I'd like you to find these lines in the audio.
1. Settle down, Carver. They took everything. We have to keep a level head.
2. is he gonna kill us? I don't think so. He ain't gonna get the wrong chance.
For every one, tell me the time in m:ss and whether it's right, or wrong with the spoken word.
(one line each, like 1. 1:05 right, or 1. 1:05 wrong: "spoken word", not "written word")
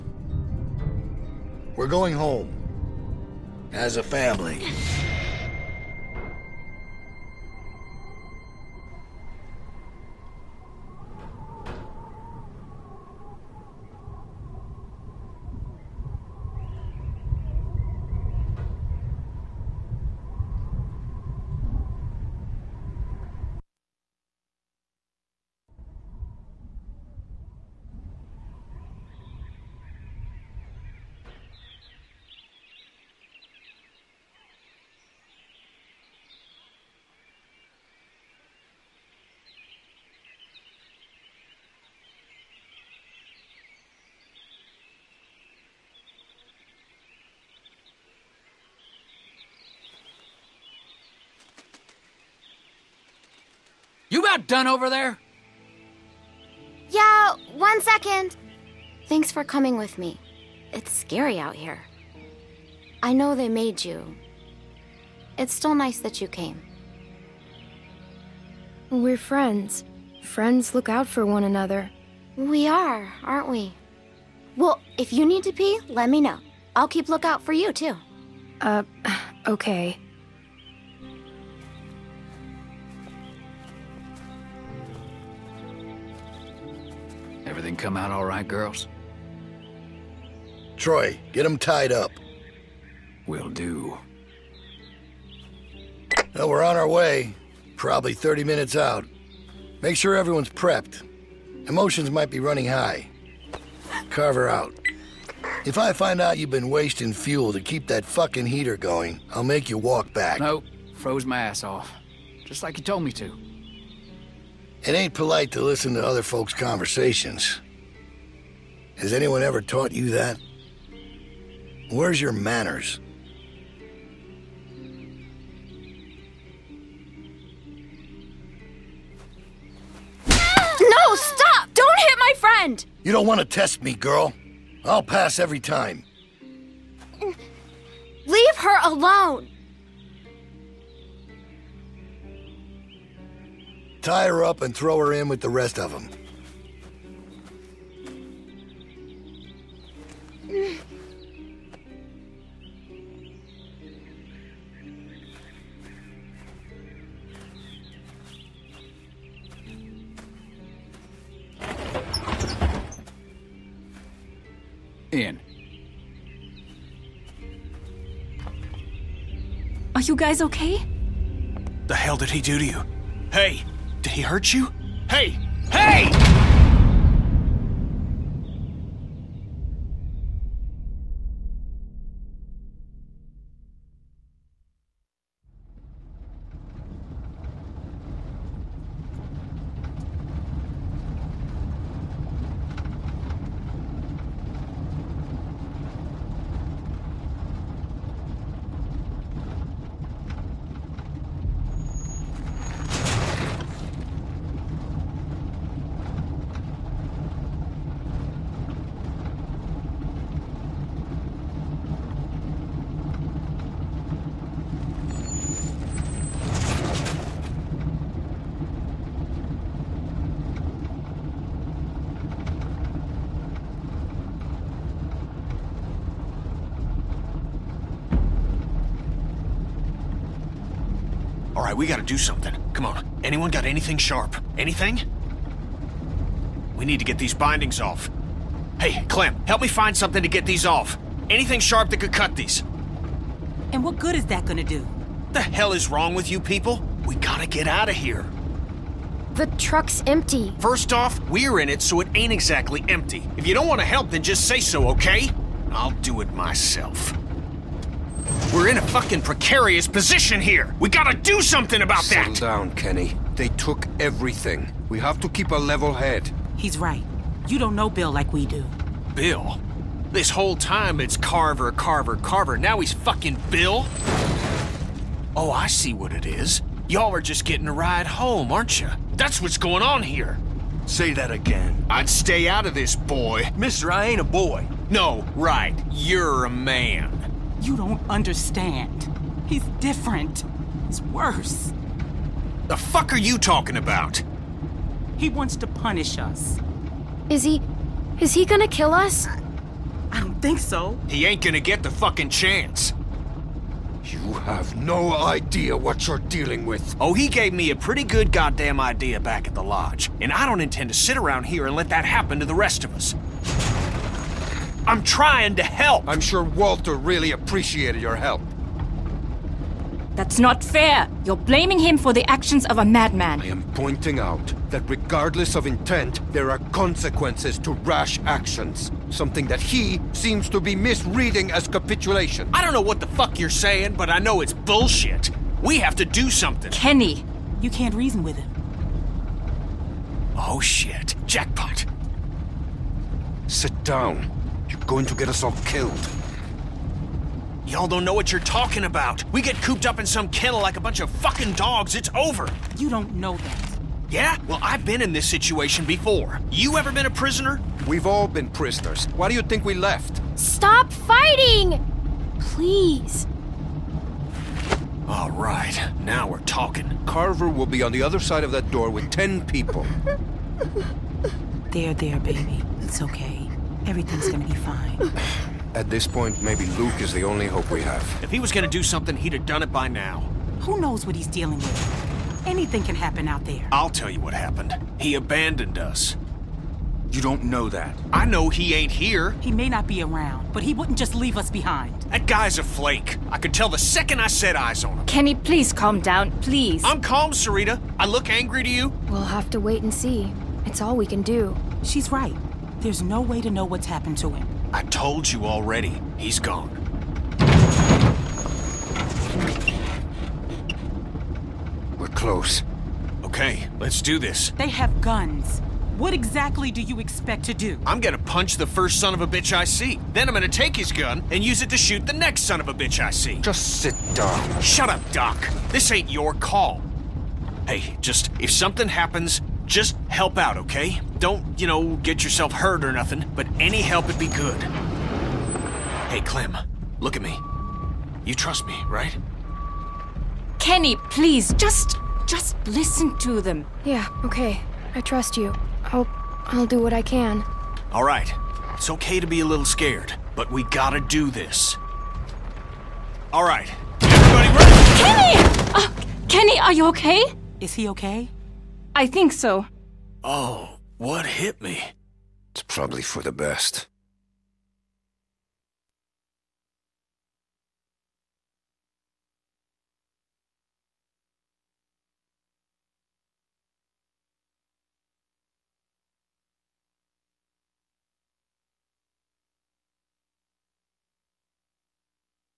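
1. 4:22 wrong: "Kenny", not "Carver"
2. 4:58 wrong: "fucking", not "wrong".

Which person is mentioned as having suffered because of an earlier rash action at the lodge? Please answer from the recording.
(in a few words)
Walter.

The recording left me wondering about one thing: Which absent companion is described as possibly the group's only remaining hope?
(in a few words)
Luke.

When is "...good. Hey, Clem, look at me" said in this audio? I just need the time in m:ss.
7:14.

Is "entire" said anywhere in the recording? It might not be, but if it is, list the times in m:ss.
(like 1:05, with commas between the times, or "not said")
not said.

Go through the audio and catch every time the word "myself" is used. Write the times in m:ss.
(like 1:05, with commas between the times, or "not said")
4:16.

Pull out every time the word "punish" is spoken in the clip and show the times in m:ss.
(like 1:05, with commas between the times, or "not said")
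4:55.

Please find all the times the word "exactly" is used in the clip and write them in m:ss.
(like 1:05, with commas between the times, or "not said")
4:12, 6:56.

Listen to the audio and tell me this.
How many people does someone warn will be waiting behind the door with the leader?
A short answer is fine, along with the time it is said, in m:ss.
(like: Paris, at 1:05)
10, at 6:09.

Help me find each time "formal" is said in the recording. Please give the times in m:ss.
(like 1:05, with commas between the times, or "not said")
not said.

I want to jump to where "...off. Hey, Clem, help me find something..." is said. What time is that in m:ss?
3:57.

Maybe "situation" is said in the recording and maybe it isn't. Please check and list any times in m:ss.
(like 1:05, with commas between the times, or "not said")
5:55.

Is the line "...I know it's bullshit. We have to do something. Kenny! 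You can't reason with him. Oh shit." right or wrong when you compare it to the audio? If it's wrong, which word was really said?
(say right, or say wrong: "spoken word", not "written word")
right.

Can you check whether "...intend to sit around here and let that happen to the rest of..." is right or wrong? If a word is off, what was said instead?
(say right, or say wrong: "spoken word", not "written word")
right.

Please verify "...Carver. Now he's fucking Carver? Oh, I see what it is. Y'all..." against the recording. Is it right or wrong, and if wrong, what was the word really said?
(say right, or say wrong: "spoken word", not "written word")
wrong: "Bill", not "Carver".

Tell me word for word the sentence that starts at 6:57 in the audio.
I'm gonna punch the first son of a bitch I see.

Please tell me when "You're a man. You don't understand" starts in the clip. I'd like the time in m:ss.
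4:45.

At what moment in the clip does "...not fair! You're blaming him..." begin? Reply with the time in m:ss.
5:20.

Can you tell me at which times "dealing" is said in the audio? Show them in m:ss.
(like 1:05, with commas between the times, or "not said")
5:06, 6:21.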